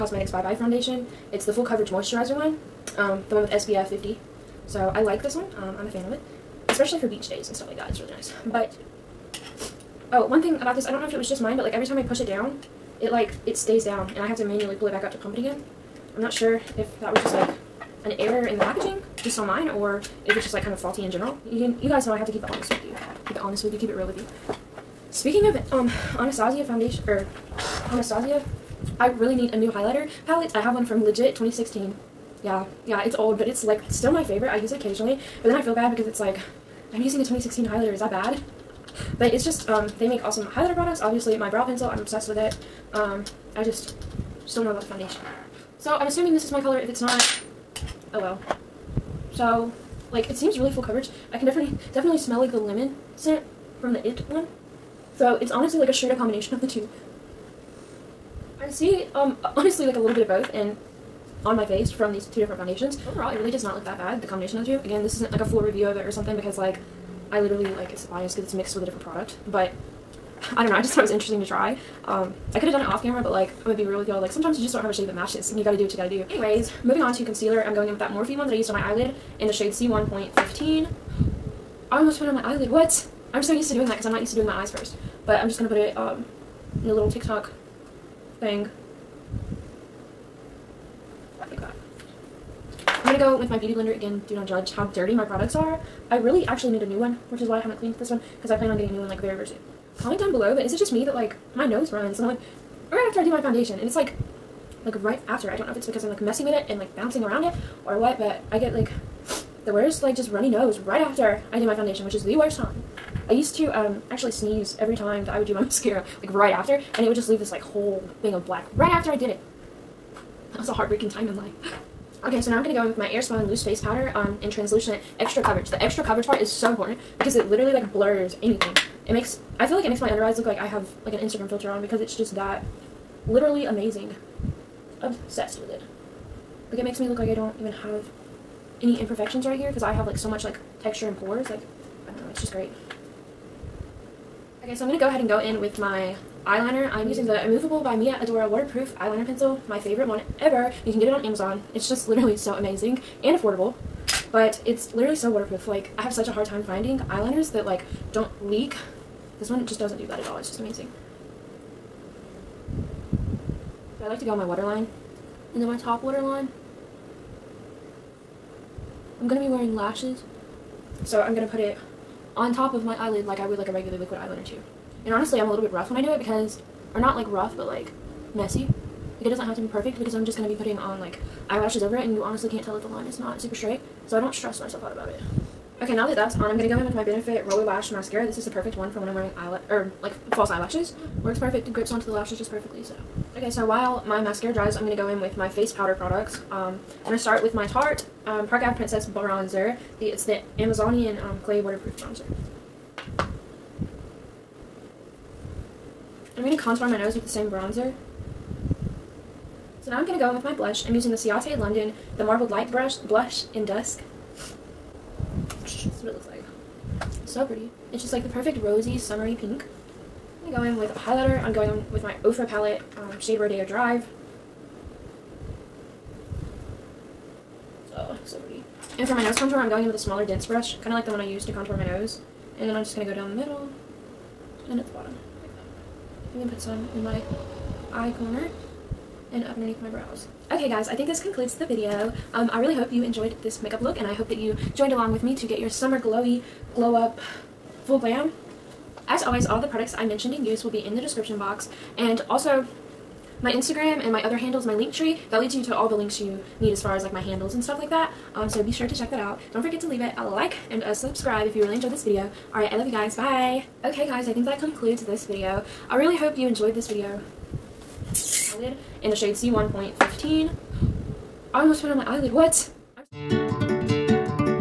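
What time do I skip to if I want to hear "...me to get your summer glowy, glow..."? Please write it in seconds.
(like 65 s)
245 s.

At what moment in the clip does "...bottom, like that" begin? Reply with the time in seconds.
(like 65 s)
234 s.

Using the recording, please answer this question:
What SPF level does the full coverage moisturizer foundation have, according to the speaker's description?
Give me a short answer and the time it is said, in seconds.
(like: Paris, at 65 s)
SPF 50, at 3 s.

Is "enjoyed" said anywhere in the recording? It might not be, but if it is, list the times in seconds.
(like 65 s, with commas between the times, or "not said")
243 s, 261 s, 266 s.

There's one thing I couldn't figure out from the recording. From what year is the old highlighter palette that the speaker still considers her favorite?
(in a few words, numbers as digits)
2016.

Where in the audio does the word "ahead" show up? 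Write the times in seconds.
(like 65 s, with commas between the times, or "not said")
145 s.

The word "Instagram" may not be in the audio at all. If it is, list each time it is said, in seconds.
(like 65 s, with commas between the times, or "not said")
131 s, 253 s.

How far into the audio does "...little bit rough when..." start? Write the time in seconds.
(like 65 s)
175 s.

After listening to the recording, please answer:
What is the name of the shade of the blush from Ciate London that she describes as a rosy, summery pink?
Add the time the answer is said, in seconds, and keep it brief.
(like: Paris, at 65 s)
Dusk, at 213 s.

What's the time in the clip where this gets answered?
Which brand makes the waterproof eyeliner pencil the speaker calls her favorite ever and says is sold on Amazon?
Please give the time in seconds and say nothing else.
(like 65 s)
147 s.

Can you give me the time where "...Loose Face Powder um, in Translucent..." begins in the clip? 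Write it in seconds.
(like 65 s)
123 s.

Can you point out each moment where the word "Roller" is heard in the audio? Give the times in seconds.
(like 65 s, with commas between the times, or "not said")
187 s.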